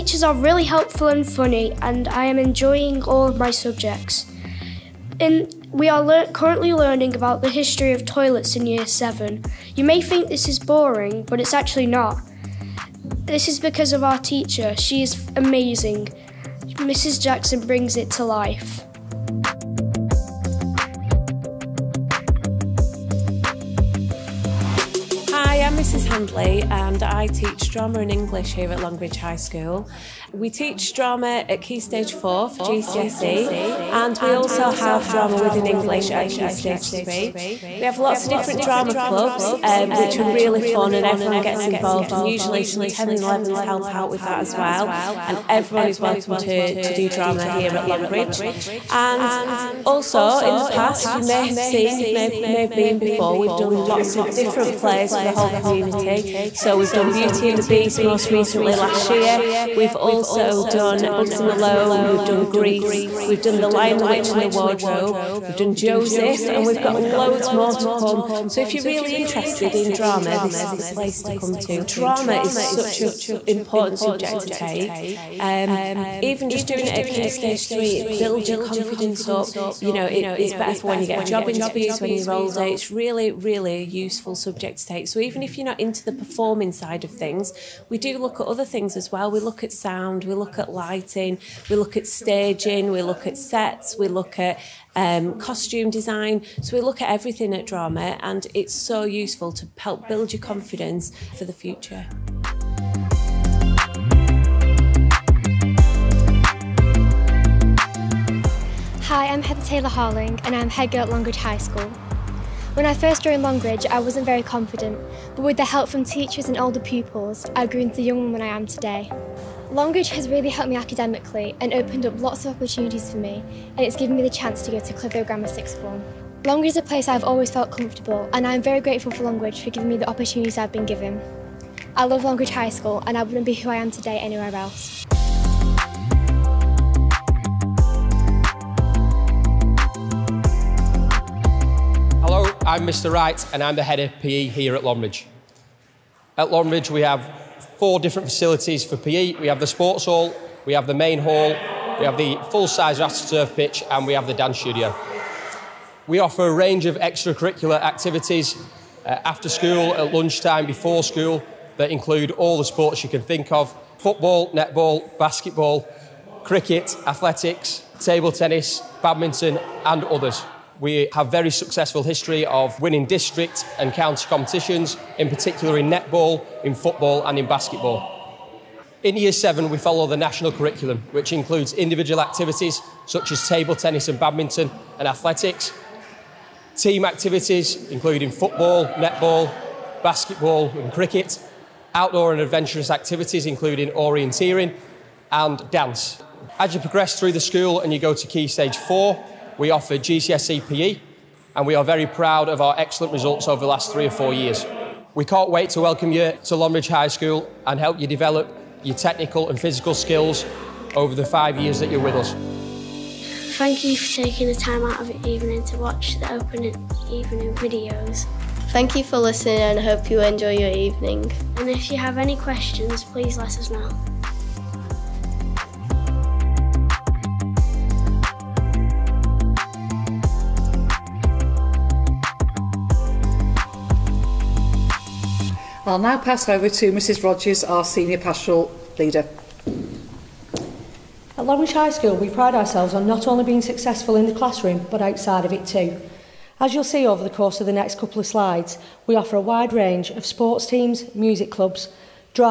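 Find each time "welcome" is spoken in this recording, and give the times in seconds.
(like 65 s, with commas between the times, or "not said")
45 s, 205 s.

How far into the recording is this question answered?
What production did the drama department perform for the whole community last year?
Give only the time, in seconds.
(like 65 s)
57 s.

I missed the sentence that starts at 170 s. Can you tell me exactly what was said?
We have very successful history of winning district and county competitions, in particular in netball, in football and in basketball.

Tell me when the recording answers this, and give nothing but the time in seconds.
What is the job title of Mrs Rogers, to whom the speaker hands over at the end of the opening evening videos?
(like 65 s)
237 s.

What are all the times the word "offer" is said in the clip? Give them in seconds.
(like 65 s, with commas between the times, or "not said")
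156 s, 199 s, 249 s.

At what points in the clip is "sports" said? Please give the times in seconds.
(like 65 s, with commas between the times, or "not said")
149 s, 162 s, 250 s.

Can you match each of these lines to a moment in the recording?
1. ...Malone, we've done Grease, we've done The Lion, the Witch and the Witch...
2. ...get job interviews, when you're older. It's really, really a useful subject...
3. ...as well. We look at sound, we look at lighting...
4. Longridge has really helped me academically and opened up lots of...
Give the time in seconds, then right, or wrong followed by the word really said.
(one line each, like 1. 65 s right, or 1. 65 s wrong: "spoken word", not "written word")
1. 61 s wrong: "Wardrobe", not "Witch"
2. 81 s right
3. 88 s right
4. 119 s right.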